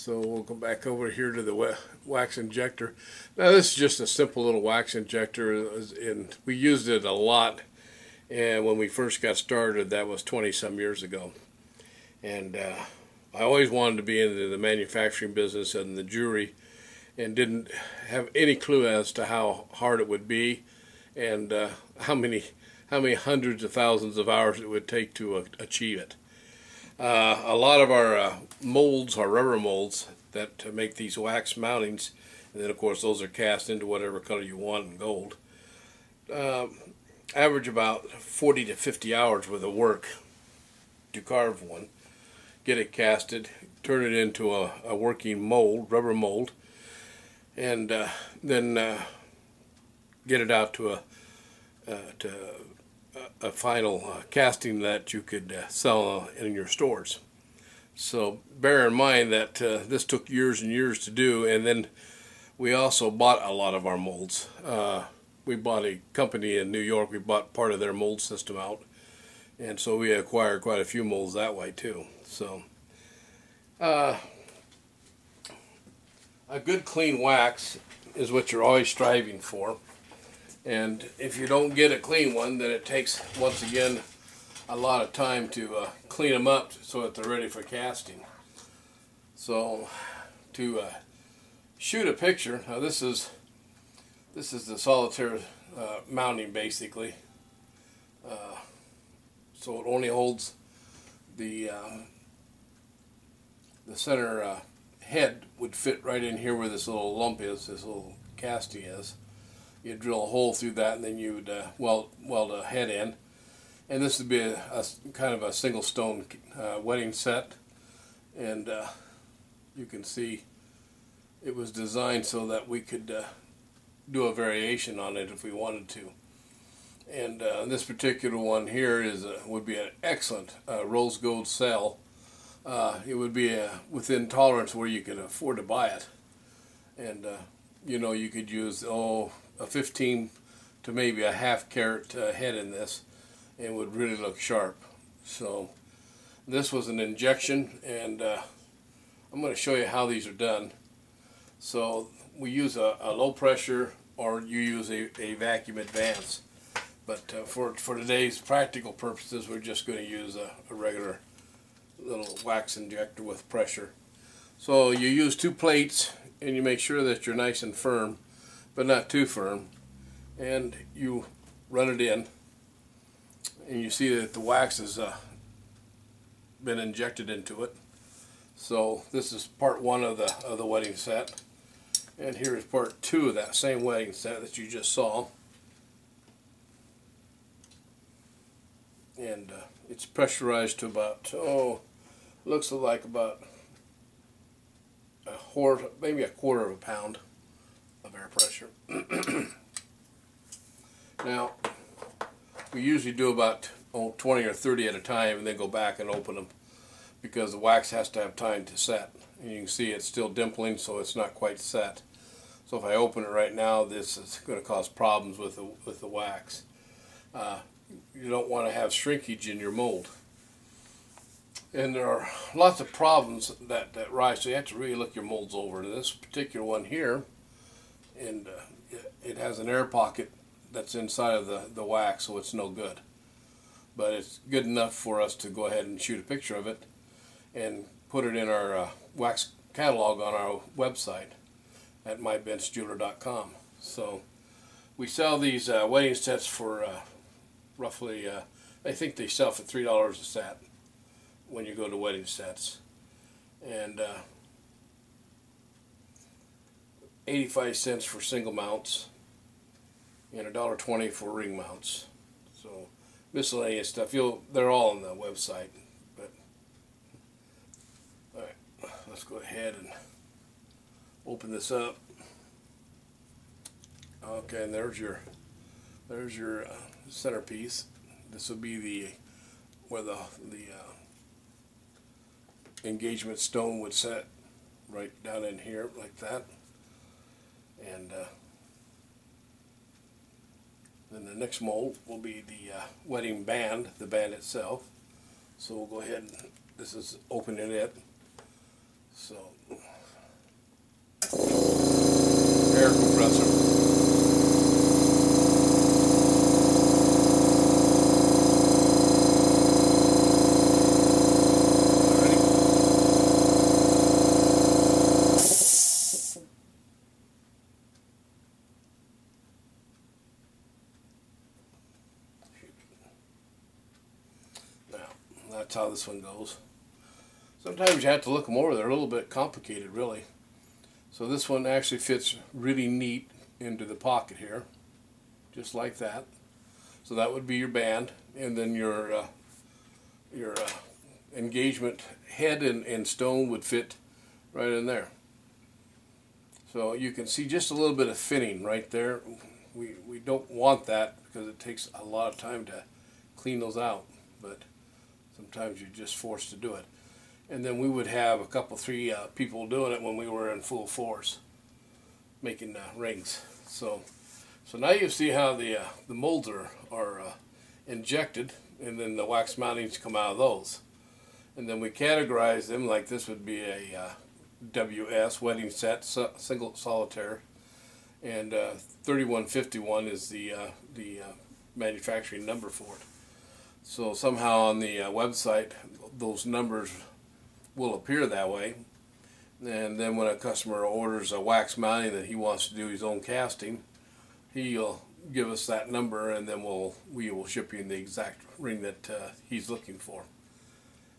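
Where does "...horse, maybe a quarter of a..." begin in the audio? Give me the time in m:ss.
3:15.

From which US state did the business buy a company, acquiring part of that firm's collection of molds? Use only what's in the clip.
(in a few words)
New York.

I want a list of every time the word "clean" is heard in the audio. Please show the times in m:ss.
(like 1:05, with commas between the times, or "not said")
1:16, 1:21, 1:26, 5:53.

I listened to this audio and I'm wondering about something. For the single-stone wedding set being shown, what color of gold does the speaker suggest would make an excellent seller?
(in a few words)
rose gold.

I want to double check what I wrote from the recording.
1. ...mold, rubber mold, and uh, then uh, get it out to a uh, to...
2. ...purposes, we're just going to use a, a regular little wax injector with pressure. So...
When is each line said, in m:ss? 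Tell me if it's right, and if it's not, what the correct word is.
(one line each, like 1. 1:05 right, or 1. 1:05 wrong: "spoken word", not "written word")
1. 0:45 right
2. 2:38 right.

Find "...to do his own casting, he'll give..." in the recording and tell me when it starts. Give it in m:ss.
6:32.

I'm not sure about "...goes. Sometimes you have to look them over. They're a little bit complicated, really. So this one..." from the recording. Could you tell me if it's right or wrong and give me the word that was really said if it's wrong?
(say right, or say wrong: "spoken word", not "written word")
right.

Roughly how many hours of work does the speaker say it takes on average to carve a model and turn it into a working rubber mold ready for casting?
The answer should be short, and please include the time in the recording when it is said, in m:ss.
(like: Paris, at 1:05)
40 to 50 hours, at 0:38.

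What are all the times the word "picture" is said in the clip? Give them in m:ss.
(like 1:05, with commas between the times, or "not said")
1:32, 3:56.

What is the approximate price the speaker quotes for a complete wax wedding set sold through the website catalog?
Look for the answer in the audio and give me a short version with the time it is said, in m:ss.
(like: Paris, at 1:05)
$3, at 4:09.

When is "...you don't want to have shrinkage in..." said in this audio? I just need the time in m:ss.
3:38.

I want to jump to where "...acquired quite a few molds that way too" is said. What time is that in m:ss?
1:10.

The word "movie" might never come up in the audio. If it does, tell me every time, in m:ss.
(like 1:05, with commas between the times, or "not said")
not said.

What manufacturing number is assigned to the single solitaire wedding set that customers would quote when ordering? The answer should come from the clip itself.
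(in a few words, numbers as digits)
3151.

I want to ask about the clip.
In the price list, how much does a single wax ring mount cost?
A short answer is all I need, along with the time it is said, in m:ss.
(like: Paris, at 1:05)
$1.20, at 4:20.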